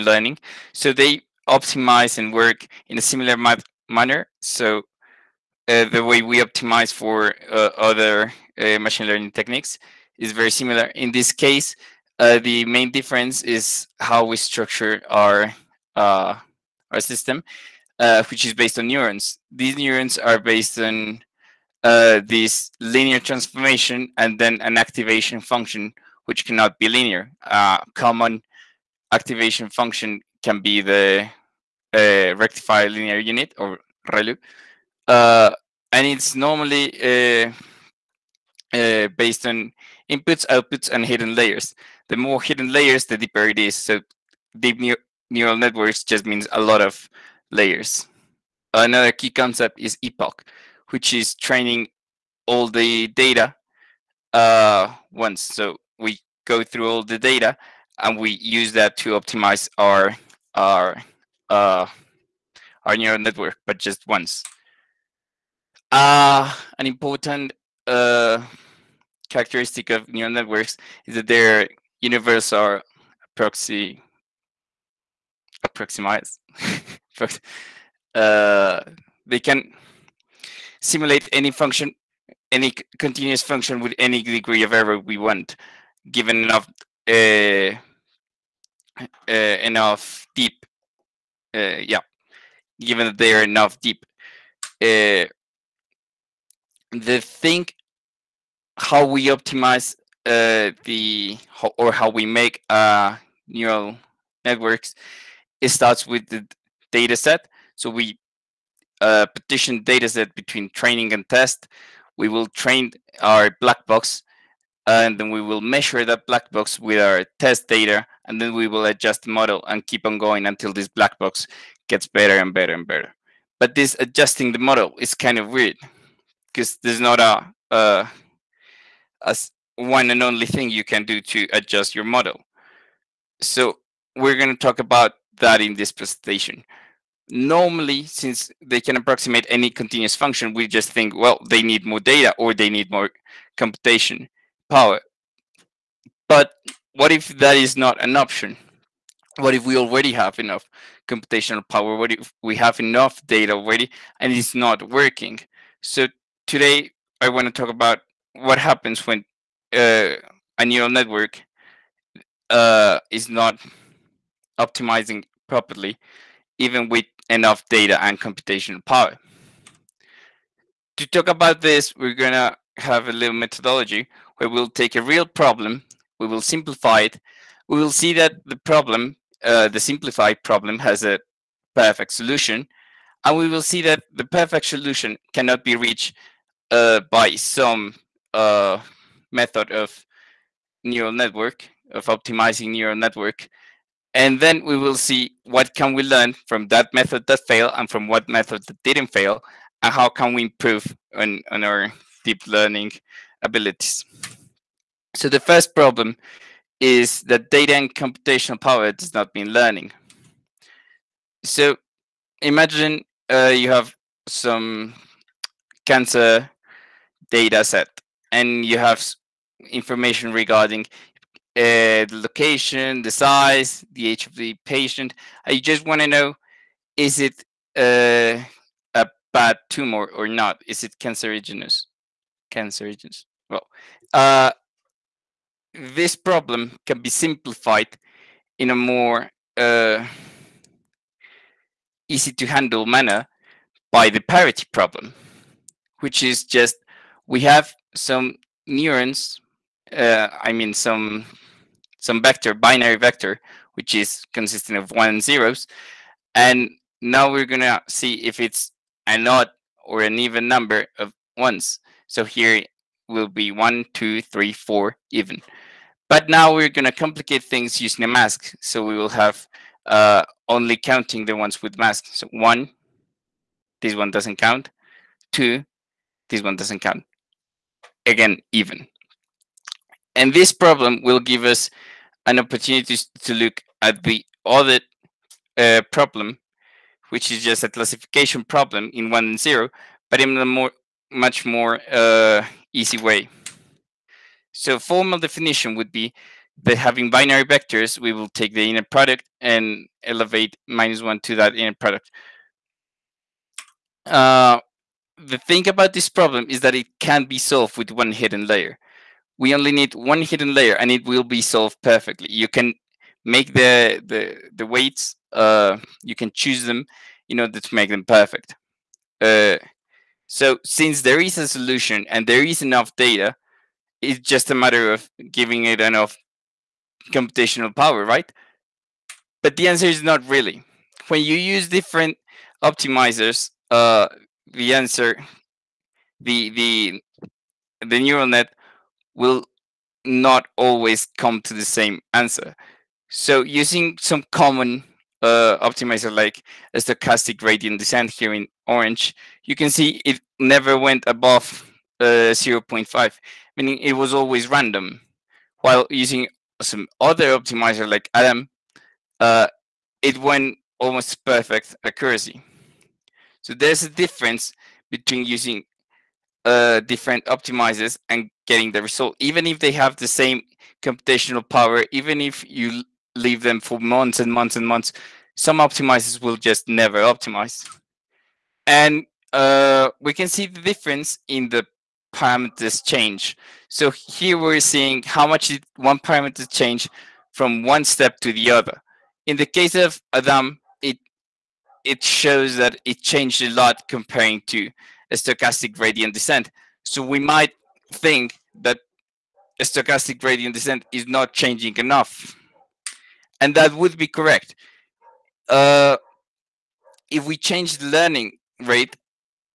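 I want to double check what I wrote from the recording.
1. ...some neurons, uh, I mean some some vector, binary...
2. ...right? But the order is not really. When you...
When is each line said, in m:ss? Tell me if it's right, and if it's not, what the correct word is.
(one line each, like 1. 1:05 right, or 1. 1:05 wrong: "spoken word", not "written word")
1. 4:07 right
2. 5:28 wrong: "answer", not "order".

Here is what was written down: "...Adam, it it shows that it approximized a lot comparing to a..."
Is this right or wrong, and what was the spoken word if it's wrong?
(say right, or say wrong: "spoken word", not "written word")
wrong: "changed", not "approximized".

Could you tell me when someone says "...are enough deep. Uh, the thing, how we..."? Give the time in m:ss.
1:33.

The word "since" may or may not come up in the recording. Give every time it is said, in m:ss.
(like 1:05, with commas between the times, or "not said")
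2:18, 5:20.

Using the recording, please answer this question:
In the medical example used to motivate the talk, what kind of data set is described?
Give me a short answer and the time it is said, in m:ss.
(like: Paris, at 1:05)
cancer data set, at 3:35.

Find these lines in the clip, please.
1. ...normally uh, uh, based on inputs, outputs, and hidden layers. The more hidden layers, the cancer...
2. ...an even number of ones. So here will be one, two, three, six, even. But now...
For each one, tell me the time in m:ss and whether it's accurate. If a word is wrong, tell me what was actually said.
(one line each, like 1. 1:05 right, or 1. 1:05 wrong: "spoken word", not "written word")
1. 0:36 wrong: "deeper", not "cancer"
2. 4:20 wrong: "four", not "six".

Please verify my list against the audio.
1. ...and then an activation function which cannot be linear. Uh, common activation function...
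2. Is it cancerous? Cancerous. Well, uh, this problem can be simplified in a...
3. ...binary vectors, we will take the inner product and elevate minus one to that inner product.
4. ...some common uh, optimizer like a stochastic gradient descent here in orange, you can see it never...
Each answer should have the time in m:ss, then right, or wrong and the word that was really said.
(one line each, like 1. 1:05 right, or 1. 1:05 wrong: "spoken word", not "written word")
1. 0:24 right
2. 3:50 right
3. 4:57 right
4. 5:43 right.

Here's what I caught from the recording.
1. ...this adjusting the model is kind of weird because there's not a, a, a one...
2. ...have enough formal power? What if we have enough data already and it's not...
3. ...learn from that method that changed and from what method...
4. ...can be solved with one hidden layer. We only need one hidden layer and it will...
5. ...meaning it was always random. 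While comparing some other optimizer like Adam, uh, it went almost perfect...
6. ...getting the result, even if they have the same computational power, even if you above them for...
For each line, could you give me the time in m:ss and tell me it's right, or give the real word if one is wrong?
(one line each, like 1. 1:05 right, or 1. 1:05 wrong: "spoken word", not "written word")
1. 2:03 right
2. 2:30 wrong: "computational", not "formal"
3. 3:16 wrong: "failed", not "changed"
4. 5:06 right
5. 5:53 wrong: "using", not "comparing"
6. 6:08 wrong: "leave", not "above".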